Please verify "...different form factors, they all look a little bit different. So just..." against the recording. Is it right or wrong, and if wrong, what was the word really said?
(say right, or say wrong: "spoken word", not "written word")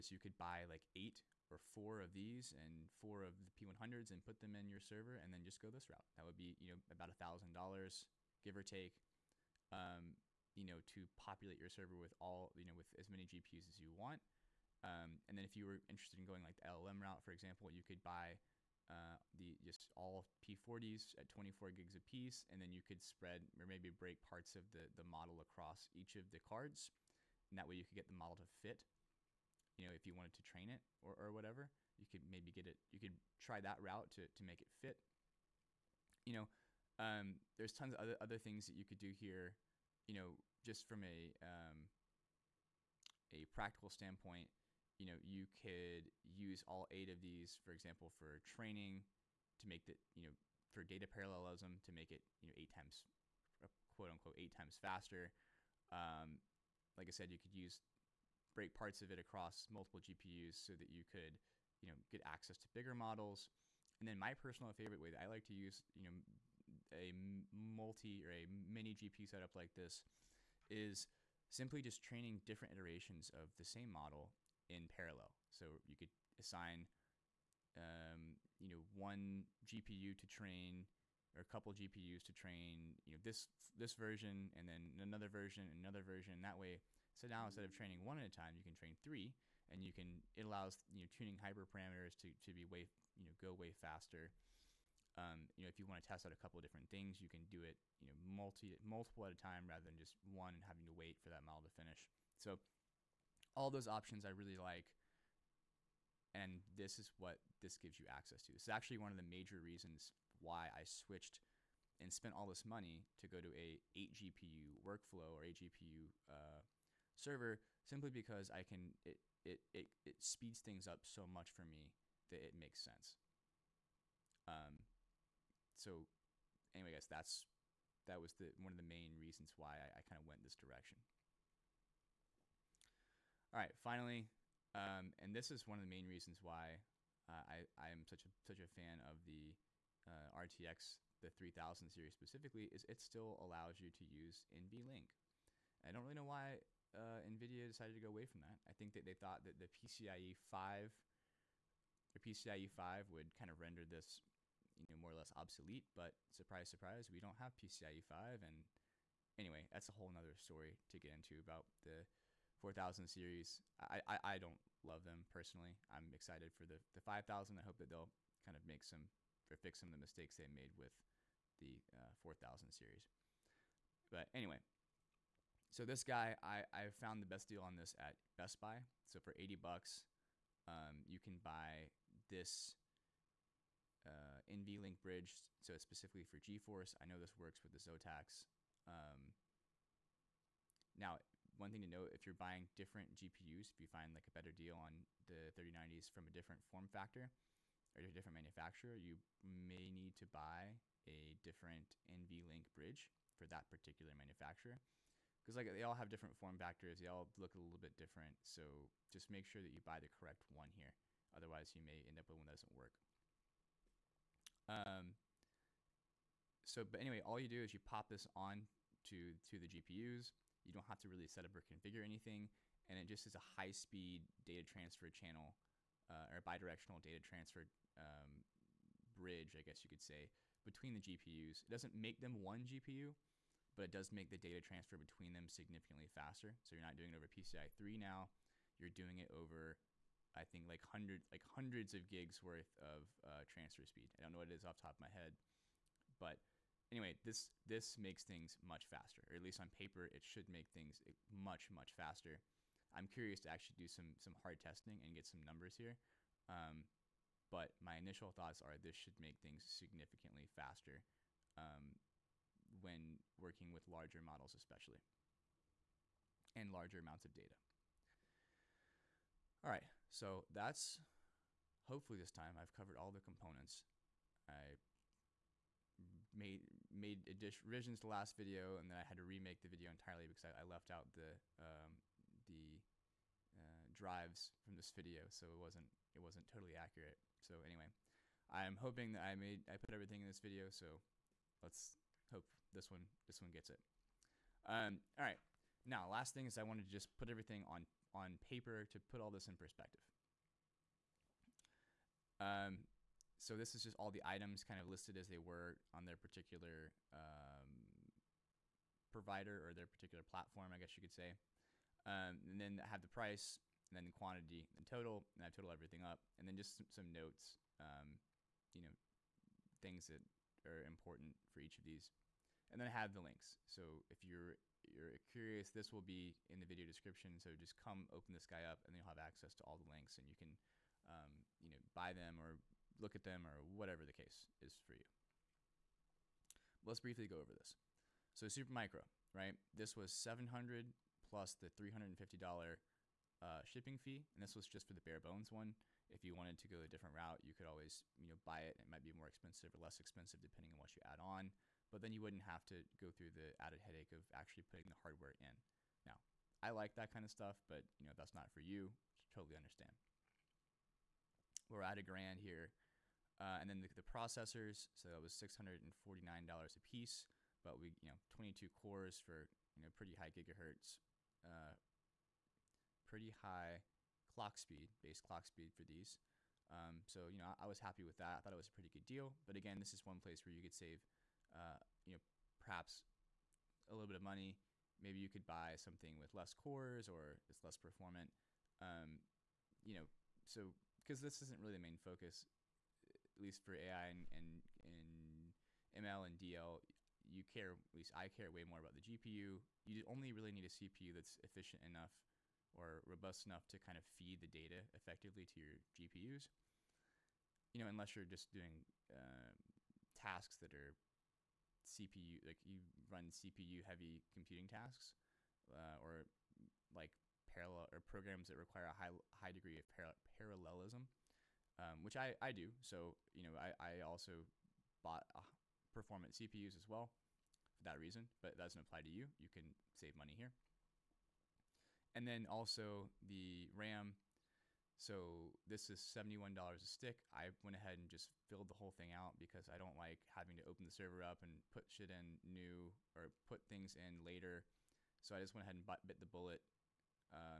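right.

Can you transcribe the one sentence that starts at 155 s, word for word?
But surprise, surprise, we don't have PCIe 5.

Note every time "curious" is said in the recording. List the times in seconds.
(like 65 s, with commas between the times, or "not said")
253 s, 325 s.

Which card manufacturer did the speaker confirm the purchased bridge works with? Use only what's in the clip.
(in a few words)
Zotac.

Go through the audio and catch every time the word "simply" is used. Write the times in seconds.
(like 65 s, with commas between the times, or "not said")
71 s, 117 s.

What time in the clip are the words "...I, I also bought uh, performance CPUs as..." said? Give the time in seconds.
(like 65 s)
423 s.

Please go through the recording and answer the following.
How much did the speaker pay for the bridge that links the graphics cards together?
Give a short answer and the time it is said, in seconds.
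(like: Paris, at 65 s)
$80, at 179 s.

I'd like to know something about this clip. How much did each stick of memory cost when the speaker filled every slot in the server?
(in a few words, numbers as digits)
$71.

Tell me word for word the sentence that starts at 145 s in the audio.
I don't really know why uh, NVIDIA decided to go away from that.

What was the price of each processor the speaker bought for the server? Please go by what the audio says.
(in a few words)
$649.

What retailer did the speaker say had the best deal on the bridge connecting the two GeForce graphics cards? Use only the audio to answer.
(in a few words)
Best Buy.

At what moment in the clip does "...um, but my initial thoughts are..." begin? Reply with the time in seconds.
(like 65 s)
256 s.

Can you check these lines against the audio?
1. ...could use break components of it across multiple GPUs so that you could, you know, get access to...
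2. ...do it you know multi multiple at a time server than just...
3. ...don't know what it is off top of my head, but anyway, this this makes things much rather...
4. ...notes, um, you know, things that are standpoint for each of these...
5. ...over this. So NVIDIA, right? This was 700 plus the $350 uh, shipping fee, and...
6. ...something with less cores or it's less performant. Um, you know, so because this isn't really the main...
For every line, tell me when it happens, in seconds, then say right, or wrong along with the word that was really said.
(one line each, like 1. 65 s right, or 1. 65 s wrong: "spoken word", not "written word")
1. 57 s wrong: "parts", not "components"
2. 97 s wrong: "rather", not "server"
3. 244 s wrong: "faster", not "rather"
4. 317 s wrong: "important", not "standpoint"
5. 337 s wrong: "Supermicro", not "NVIDIA"
6. 385 s right.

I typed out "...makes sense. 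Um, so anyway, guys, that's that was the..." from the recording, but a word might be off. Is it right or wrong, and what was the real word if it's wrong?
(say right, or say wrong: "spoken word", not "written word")
right.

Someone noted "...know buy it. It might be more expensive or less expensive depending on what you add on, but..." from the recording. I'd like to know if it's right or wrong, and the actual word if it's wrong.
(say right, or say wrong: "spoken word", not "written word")
right.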